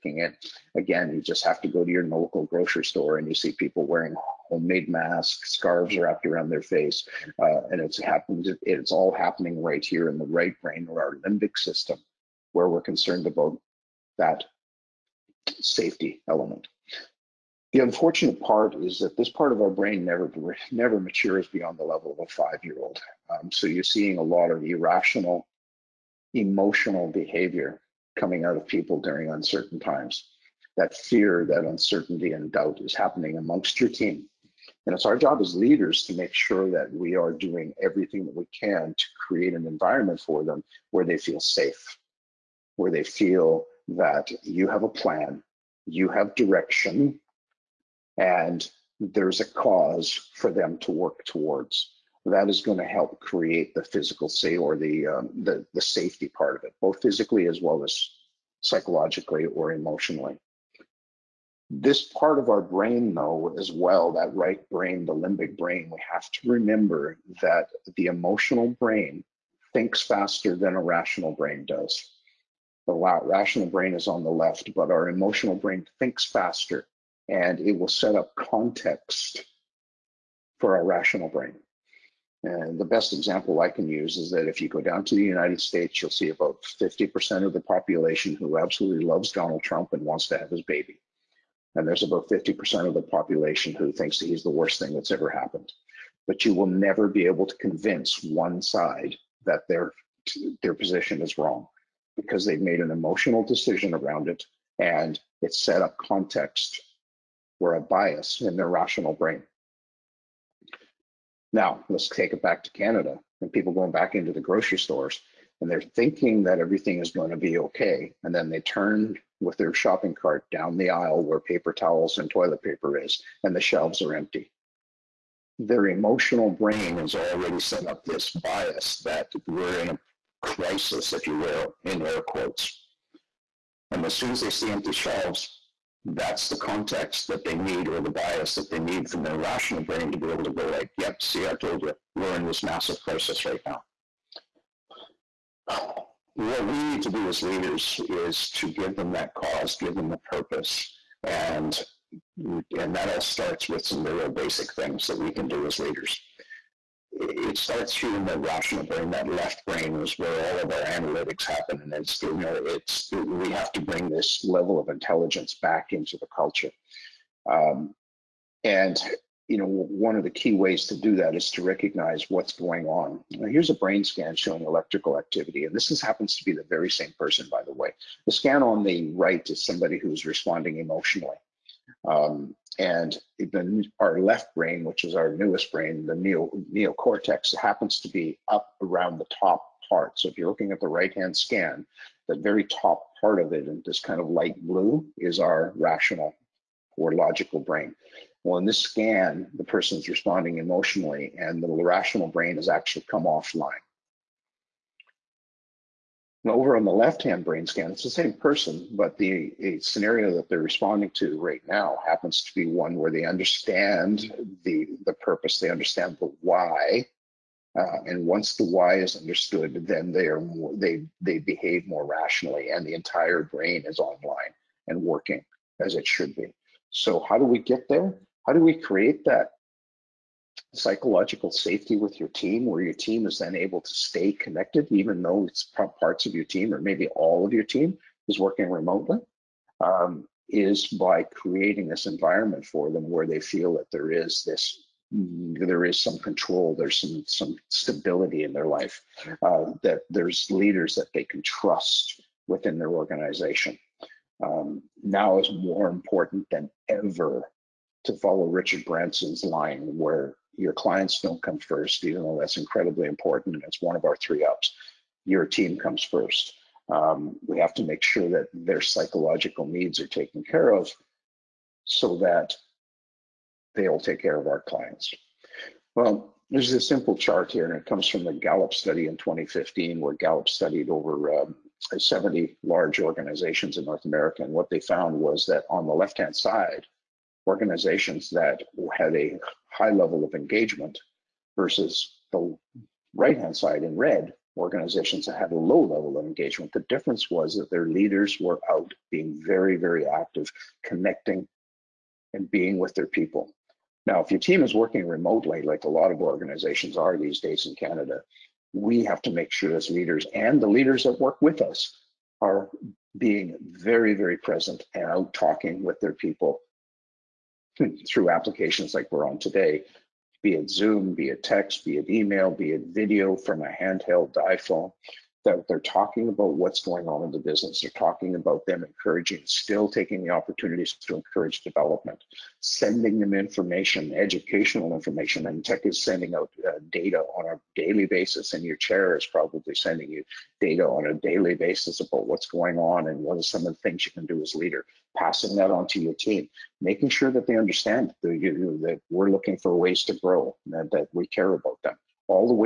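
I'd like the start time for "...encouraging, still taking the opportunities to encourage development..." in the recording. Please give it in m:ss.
5:28.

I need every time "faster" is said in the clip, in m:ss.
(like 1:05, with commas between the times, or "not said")
1:10, 1:16.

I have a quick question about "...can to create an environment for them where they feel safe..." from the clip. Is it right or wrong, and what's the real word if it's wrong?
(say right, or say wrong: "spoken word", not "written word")
right.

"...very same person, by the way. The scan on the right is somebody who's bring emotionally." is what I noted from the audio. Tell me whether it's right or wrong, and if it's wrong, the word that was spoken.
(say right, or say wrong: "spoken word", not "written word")
wrong: "responding", not "bring".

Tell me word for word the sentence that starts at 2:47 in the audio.
Um, and you know one of the key ways to do that is to recognize what's going on.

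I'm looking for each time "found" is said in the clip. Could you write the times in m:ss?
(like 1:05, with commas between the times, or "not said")
4:44.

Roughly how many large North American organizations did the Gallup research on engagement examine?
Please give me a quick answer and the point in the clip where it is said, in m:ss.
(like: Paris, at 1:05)
70, at 4:41.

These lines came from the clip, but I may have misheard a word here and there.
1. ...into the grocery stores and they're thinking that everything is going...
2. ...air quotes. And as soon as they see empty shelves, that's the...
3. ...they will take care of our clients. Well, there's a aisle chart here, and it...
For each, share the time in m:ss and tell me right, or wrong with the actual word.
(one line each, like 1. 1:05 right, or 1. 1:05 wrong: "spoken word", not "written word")
1. 1:54 right
2. 2:12 right
3. 4:33 wrong: "simple", not "aisle".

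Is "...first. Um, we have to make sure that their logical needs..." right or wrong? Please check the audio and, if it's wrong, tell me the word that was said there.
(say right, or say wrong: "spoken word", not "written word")
wrong: "psychological", not "logical".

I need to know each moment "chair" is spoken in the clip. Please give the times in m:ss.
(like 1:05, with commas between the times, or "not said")
5:38.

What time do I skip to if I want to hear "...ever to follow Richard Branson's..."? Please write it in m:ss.
4:16.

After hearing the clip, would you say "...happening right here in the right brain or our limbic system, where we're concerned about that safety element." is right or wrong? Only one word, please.
right.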